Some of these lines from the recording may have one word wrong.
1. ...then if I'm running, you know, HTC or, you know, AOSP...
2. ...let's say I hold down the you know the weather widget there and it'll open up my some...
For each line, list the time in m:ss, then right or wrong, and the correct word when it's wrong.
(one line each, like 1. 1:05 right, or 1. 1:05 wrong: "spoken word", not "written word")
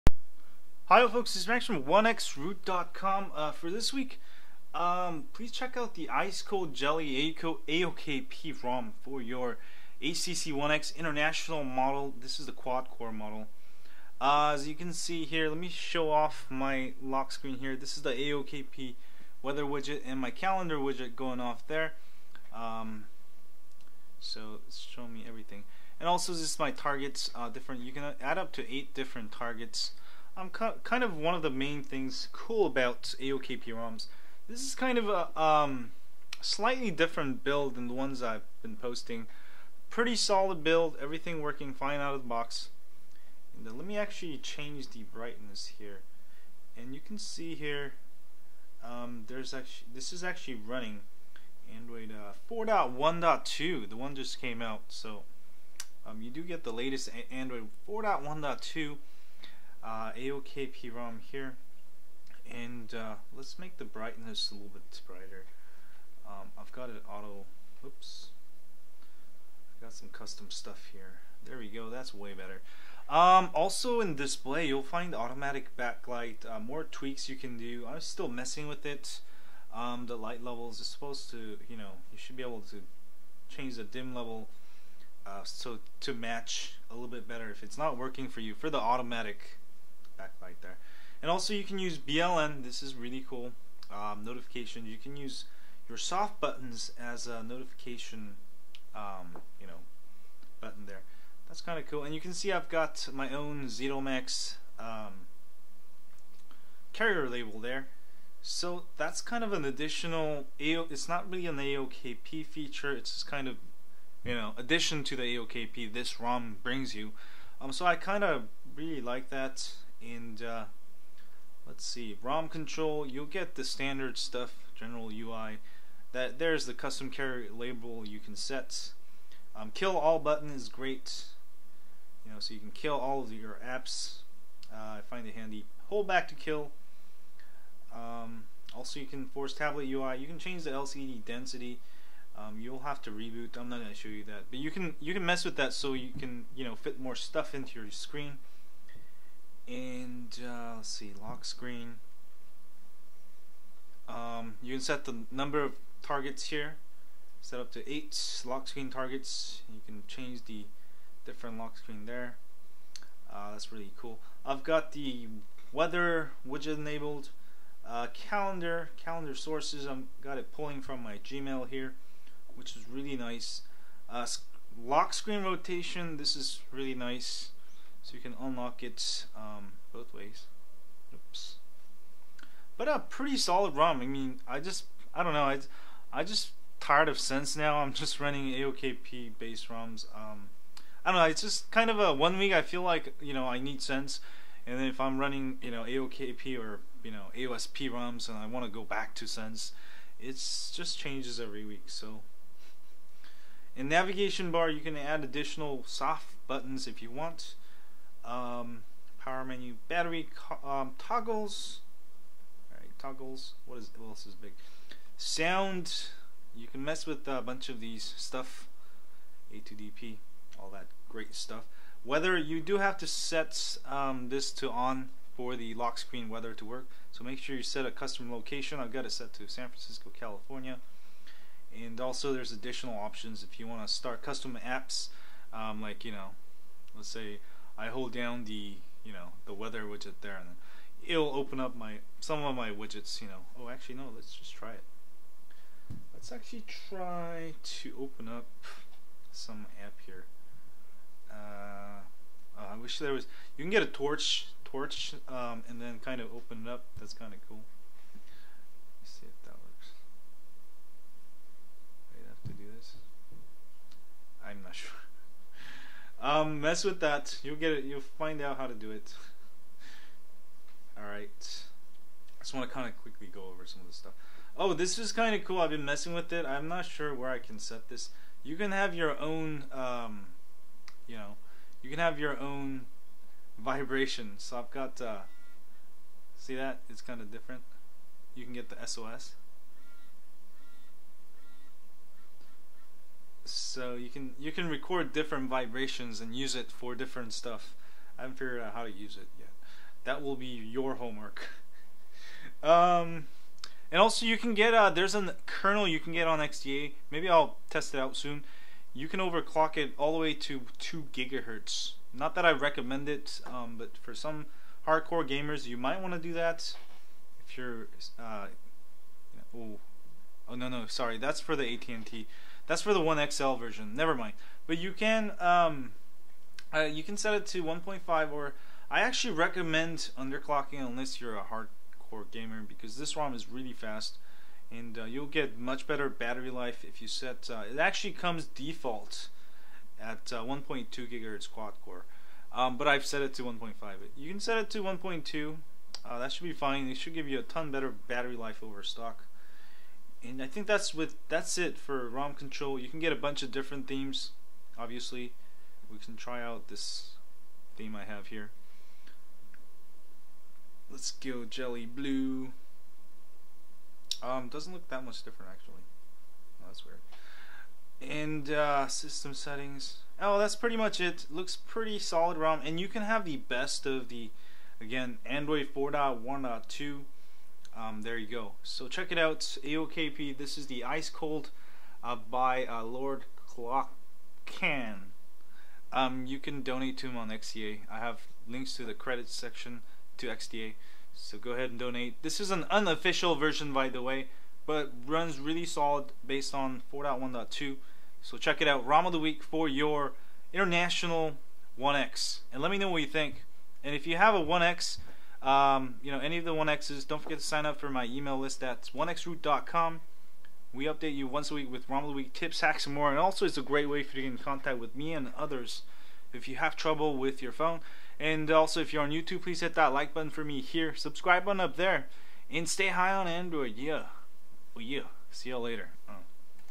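1. 3:14 wrong: "AOKP", not "HTC"
2. 3:56 right.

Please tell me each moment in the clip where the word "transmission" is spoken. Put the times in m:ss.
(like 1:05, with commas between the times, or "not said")
not said.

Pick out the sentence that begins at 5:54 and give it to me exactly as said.
Obviously, we can try out this theme I have here.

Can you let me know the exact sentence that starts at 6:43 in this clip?
And if you have a 1X, um, you know, any of the 1Xs, don't forget to sign up for my email list.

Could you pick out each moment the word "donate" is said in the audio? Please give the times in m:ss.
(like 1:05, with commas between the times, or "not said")
6:26, 6:31.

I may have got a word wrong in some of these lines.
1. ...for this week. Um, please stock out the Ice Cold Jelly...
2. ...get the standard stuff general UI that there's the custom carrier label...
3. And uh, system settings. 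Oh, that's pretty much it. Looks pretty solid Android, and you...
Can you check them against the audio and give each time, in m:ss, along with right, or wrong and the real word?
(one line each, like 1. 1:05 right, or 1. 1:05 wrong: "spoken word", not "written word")
1. 0:03 wrong: "check", not "stock"
2. 2:03 right
3. 6:08 wrong: "ROM", not "Android".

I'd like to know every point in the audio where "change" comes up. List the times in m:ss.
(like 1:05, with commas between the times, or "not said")
0:44, 1:23, 2:20, 2:40, 3:20.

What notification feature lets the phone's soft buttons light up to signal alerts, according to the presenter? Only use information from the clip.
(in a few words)
BLN.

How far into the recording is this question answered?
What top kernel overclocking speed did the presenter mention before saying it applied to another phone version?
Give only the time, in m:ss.
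5:10.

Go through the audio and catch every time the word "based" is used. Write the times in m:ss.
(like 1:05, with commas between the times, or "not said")
3:09, 6:36.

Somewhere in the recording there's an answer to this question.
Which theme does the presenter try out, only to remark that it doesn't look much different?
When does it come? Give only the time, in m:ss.
6:01.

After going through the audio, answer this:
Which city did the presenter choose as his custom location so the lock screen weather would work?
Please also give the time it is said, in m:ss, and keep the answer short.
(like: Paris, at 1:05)
San Francisco, at 3:49.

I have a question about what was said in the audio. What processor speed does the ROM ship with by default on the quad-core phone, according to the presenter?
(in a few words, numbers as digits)
1.2 gigahertz.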